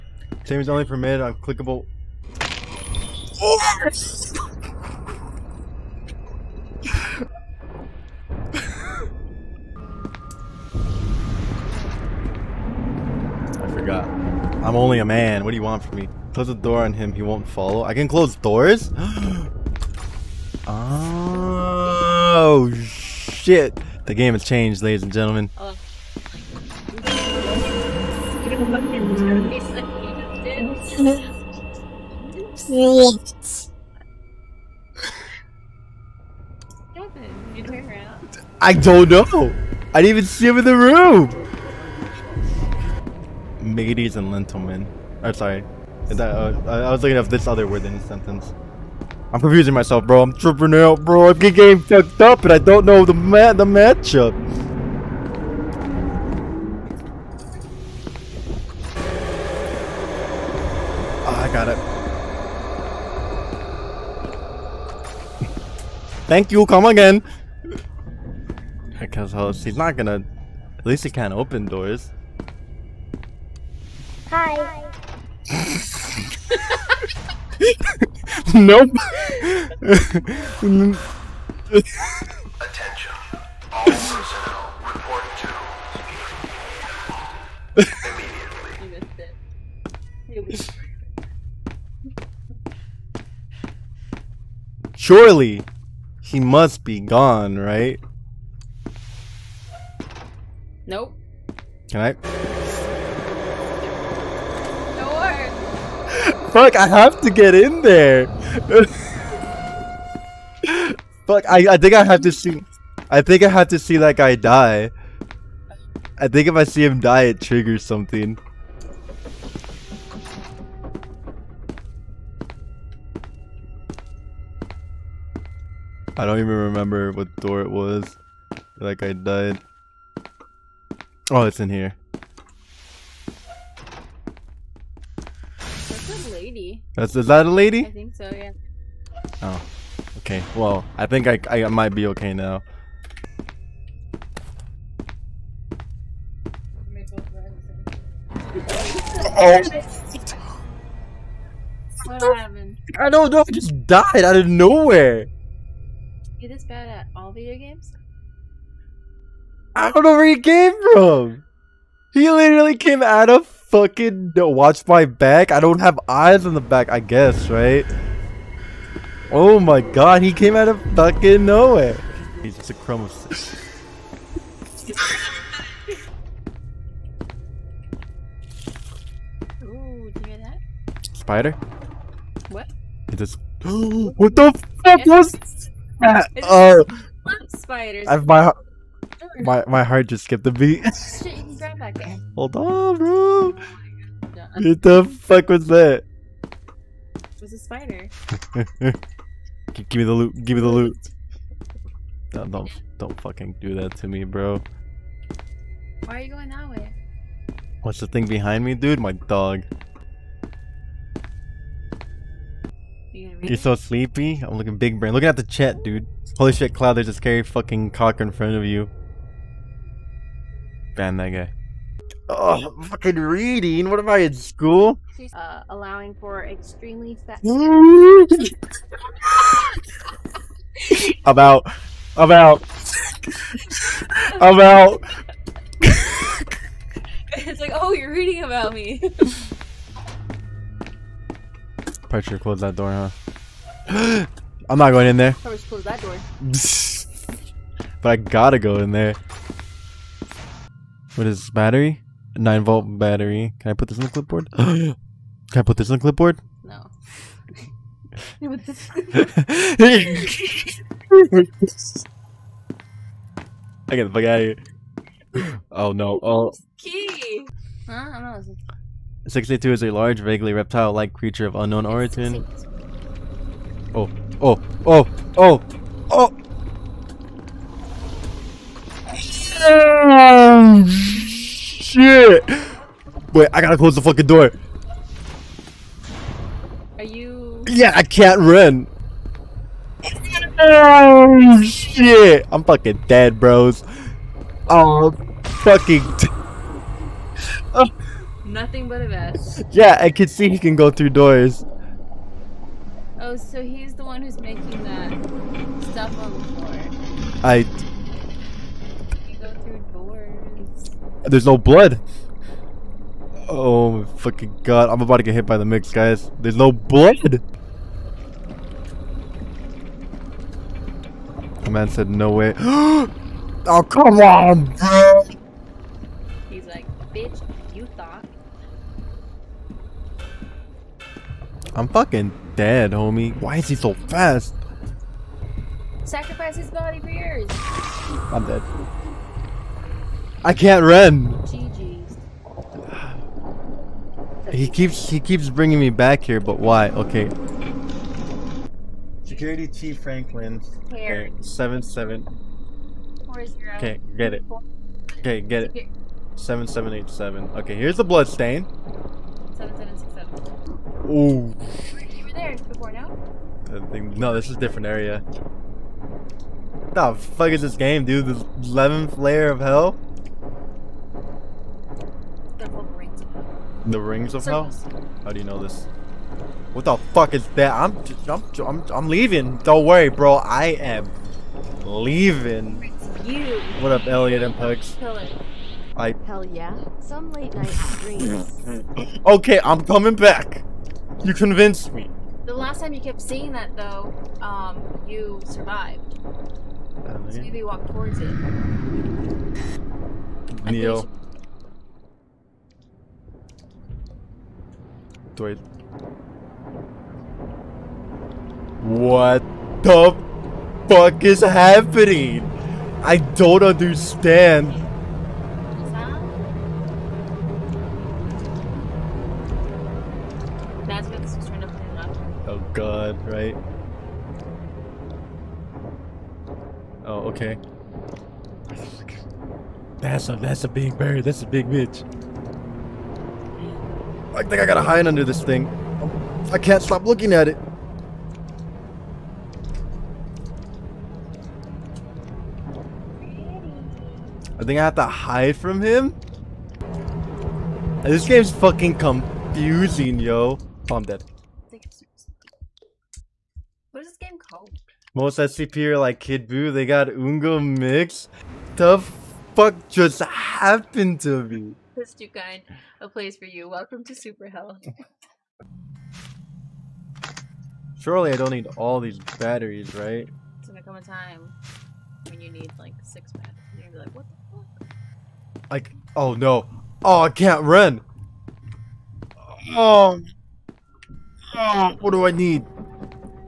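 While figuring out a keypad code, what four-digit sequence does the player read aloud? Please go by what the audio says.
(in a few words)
7787.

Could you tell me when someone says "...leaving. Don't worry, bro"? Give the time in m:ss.
6:19.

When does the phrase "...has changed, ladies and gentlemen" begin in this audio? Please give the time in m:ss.
0:24.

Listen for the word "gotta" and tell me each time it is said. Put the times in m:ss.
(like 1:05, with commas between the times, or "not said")
4:08, 4:43, 7:14.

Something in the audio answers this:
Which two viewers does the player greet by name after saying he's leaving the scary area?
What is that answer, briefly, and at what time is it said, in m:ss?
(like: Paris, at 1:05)
Elliot and Pugs, at 6:24.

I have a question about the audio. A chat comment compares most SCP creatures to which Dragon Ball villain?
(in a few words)
Kid Buu.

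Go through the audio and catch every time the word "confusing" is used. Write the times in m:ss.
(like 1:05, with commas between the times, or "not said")
0:49, 7:28.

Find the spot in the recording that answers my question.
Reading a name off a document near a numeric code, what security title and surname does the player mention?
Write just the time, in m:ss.
5:49.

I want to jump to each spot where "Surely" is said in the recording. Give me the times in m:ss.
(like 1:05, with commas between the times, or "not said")
1:35, 7:47.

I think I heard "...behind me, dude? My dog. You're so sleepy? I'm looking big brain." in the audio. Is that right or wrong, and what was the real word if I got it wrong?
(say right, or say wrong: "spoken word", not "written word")
right.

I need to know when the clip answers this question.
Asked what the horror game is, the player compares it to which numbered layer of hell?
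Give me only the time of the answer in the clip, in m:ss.
6:08.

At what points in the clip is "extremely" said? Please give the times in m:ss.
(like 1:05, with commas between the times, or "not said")
3:46.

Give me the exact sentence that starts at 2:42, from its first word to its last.
He literally came out of fucking watch my back.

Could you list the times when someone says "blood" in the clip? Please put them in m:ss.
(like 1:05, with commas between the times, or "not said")
5:11, 5:16, 5:58.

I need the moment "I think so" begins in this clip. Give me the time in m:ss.
2:17.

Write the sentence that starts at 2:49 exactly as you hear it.
Oh my god, he came out of fucking nowhere.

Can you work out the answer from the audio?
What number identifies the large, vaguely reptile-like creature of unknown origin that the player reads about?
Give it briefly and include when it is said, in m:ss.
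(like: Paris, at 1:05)
62, at 4:29.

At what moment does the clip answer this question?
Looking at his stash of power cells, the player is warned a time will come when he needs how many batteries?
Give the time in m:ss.
7:53.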